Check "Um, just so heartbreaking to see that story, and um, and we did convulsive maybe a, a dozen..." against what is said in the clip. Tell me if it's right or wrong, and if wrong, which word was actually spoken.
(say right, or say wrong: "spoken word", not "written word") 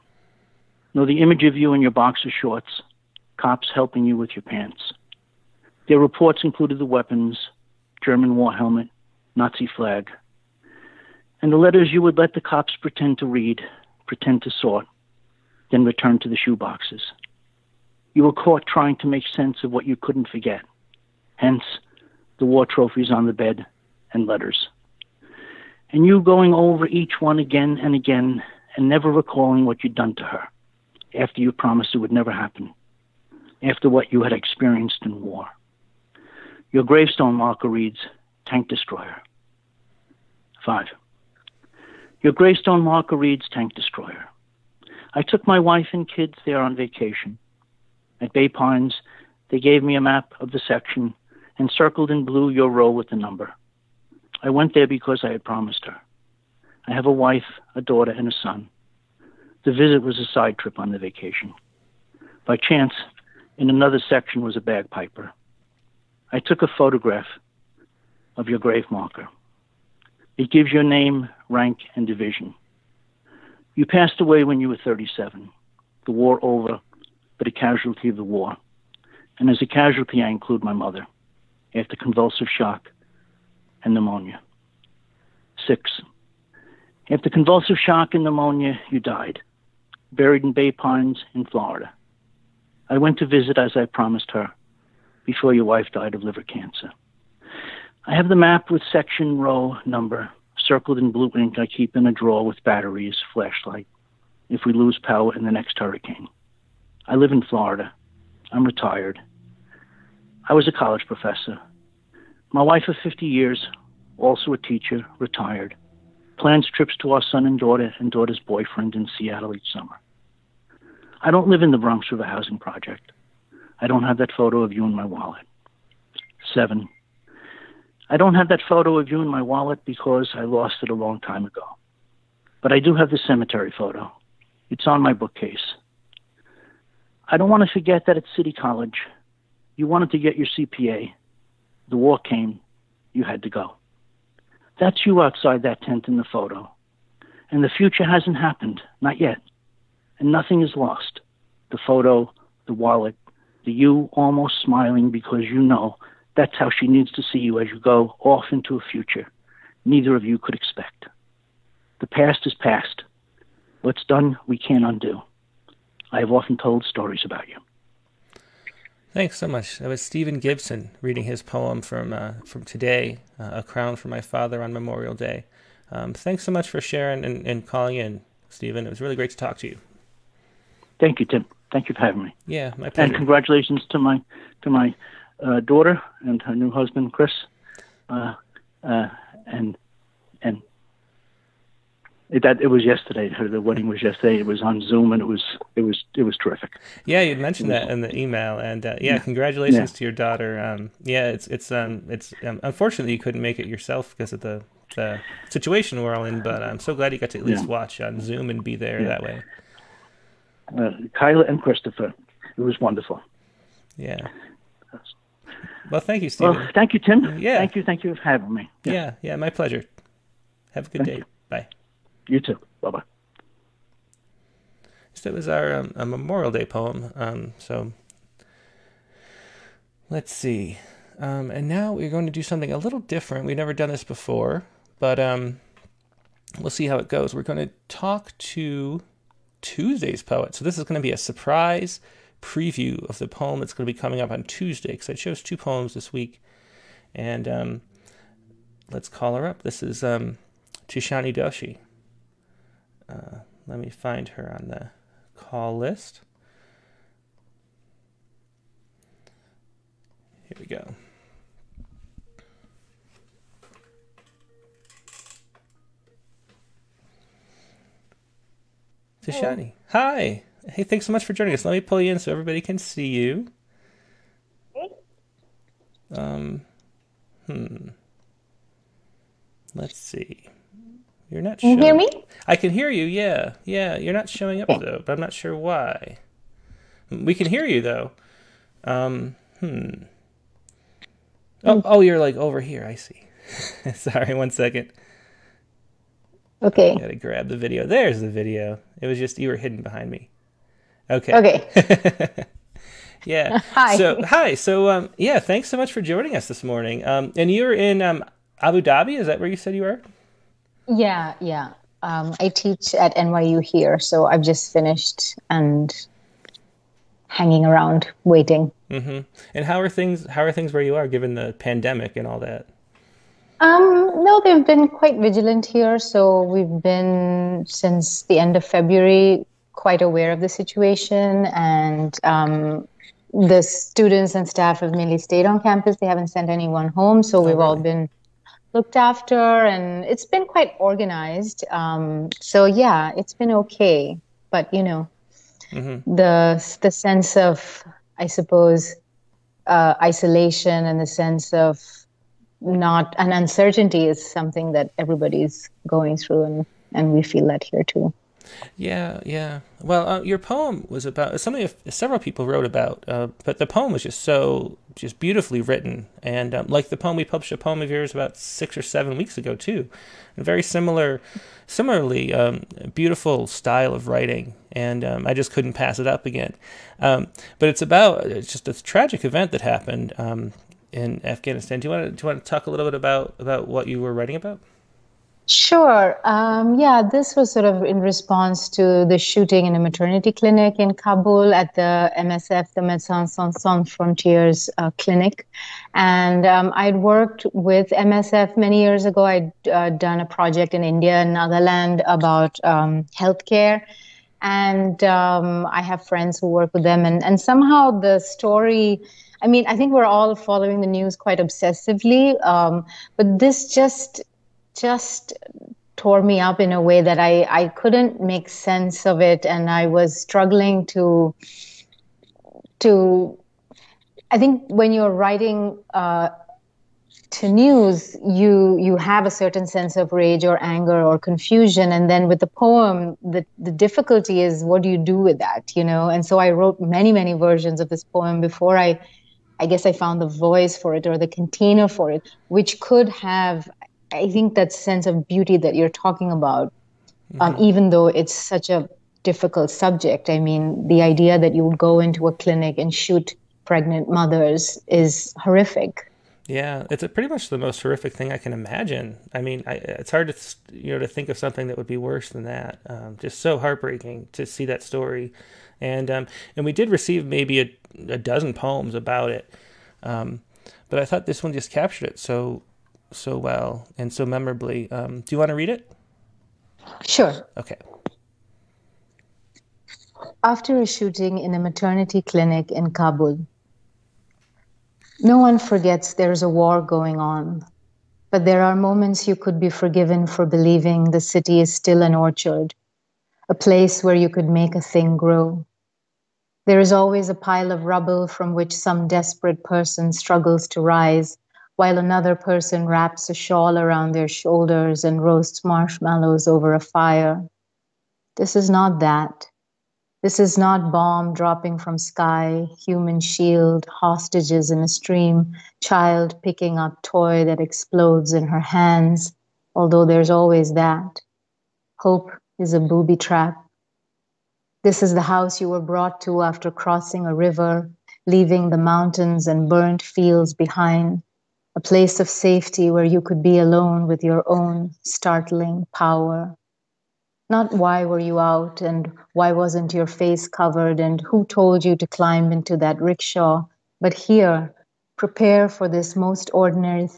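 wrong: "receive", not "convulsive".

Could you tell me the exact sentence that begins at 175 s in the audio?
Um, thanks so much for sharing and, and calling in, Stephen.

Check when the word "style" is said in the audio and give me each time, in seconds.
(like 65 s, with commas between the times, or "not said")
373 s.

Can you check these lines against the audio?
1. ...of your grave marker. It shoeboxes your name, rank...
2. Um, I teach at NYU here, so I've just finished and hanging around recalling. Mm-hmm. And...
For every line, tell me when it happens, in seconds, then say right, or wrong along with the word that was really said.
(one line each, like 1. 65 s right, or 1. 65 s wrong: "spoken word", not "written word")
1. 68 s wrong: "gives", not "shoeboxes"
2. 312 s wrong: "waiting", not "recalling".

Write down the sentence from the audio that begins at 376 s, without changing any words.
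Um, but it's about it's just a tragic event that happened um, in Afghanistan.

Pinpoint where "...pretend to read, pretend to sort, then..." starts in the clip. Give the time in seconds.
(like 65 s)
12 s.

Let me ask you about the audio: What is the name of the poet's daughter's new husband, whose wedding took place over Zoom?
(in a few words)
Chris.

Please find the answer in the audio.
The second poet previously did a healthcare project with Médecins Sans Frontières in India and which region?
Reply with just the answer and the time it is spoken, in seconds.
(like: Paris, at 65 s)
Nagaland, at 401 s.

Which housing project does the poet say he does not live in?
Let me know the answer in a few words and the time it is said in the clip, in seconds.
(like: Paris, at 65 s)
Bronx River Housing Project, at 121 s.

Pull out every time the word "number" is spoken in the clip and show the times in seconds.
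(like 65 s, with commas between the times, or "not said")
53 s, 99 s.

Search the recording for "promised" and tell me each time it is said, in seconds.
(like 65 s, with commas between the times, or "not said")
31 s, 55 s, 93 s.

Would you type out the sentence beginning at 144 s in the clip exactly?
That's you outside that tent in the photo.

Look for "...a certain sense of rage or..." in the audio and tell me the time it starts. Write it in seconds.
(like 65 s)
429 s.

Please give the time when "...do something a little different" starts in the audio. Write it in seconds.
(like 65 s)
232 s.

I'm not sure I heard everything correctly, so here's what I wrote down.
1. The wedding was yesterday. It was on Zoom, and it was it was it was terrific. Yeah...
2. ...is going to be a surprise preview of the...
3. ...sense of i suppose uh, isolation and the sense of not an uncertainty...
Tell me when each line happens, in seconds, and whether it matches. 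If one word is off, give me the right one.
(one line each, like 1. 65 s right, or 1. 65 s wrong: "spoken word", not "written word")
1. 193 s right
2. 240 s right
3. 346 s right.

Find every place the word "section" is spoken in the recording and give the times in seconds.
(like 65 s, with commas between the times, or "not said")
50 s, 64 s, 98 s.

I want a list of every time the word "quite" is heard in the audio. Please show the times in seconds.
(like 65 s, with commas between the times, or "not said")
324 s, 329 s, 340 s, 411 s.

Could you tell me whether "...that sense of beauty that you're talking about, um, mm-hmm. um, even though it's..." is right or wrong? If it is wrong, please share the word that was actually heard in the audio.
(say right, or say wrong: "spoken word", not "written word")
right.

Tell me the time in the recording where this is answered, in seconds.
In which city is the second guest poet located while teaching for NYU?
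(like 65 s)
308 s.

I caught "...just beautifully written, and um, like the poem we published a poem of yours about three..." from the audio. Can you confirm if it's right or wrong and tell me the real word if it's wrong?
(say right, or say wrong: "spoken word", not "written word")
wrong: "six", not "three".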